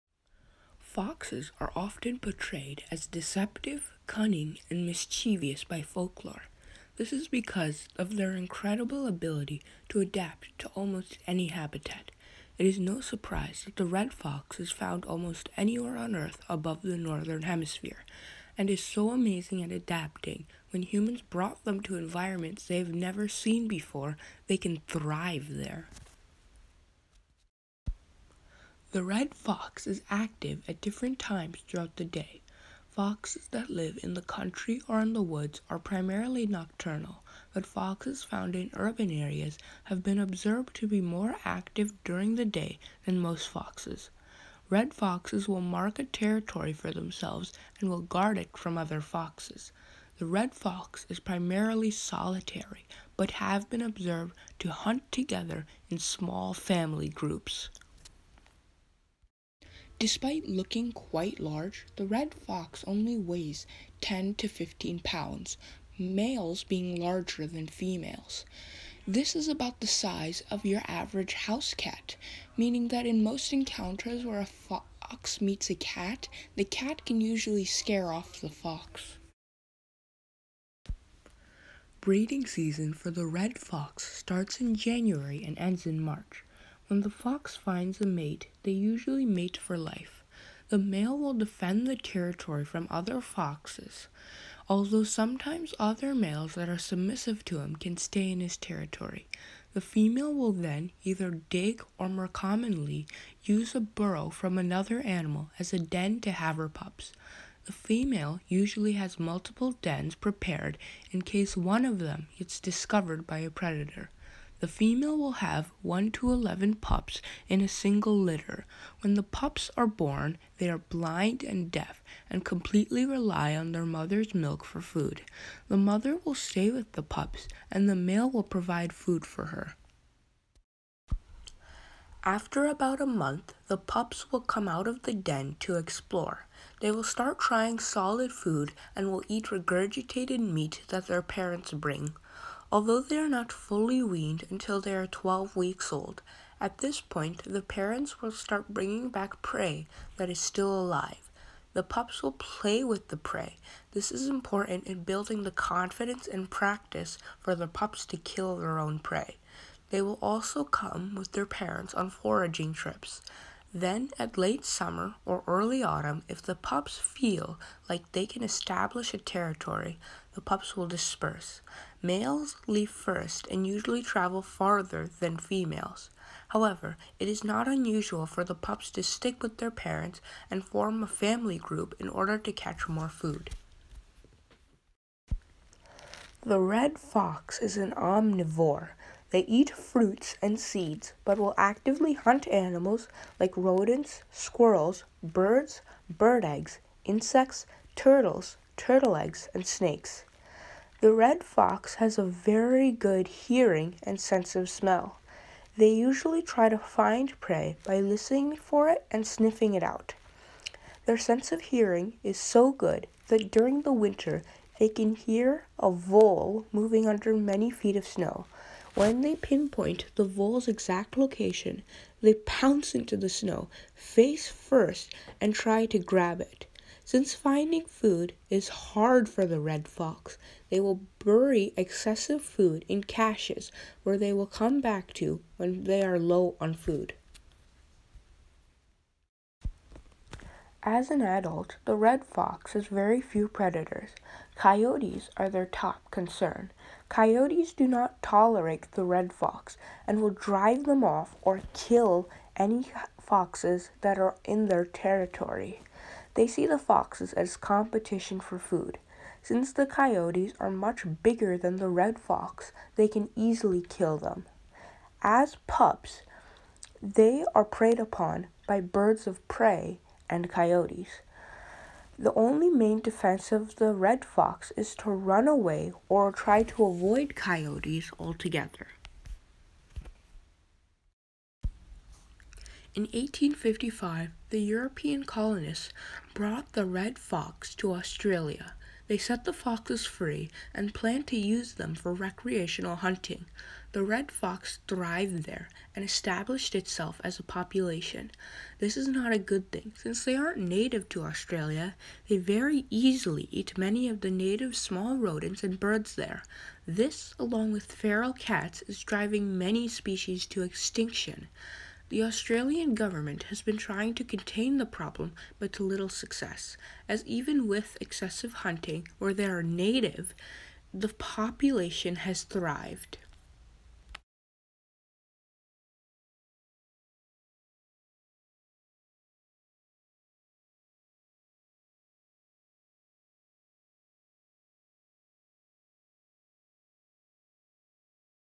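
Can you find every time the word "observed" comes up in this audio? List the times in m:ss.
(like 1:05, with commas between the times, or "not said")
0:40, 0:53.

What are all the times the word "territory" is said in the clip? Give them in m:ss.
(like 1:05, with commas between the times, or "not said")
0:46, 1:31, 1:38, 2:49, 4:14.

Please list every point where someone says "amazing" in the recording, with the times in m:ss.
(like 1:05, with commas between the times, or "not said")
0:19.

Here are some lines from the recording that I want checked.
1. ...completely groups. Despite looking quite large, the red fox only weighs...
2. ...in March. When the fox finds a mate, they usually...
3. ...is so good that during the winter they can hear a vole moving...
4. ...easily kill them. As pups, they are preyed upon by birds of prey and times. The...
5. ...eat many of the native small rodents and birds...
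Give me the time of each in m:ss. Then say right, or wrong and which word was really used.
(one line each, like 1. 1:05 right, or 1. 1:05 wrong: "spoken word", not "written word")
1. 0:56 wrong: "family", not "completely"
2. 1:25 right
3. 3:32 right
4. 4:23 wrong: "coyotes", not "times"
5. 5:03 right.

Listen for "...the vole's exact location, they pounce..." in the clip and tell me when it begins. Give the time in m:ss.
3:40.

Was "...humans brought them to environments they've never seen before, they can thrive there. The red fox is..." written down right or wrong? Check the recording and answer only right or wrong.
right.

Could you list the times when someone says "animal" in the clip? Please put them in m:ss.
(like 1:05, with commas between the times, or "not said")
1:44, 3:12.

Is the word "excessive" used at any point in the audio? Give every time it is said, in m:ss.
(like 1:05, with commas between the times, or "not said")
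3:51, 5:18.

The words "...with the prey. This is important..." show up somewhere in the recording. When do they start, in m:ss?
2:32.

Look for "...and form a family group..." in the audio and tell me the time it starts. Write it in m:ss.
3:00.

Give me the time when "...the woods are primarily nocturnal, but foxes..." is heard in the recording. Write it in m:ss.
0:35.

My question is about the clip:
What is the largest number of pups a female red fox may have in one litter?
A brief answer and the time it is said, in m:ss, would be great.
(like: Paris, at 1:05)
11, at 1:56.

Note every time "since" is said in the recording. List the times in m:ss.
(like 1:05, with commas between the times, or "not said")
3:47, 4:19, 4:59.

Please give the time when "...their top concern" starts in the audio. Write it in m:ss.
4:05.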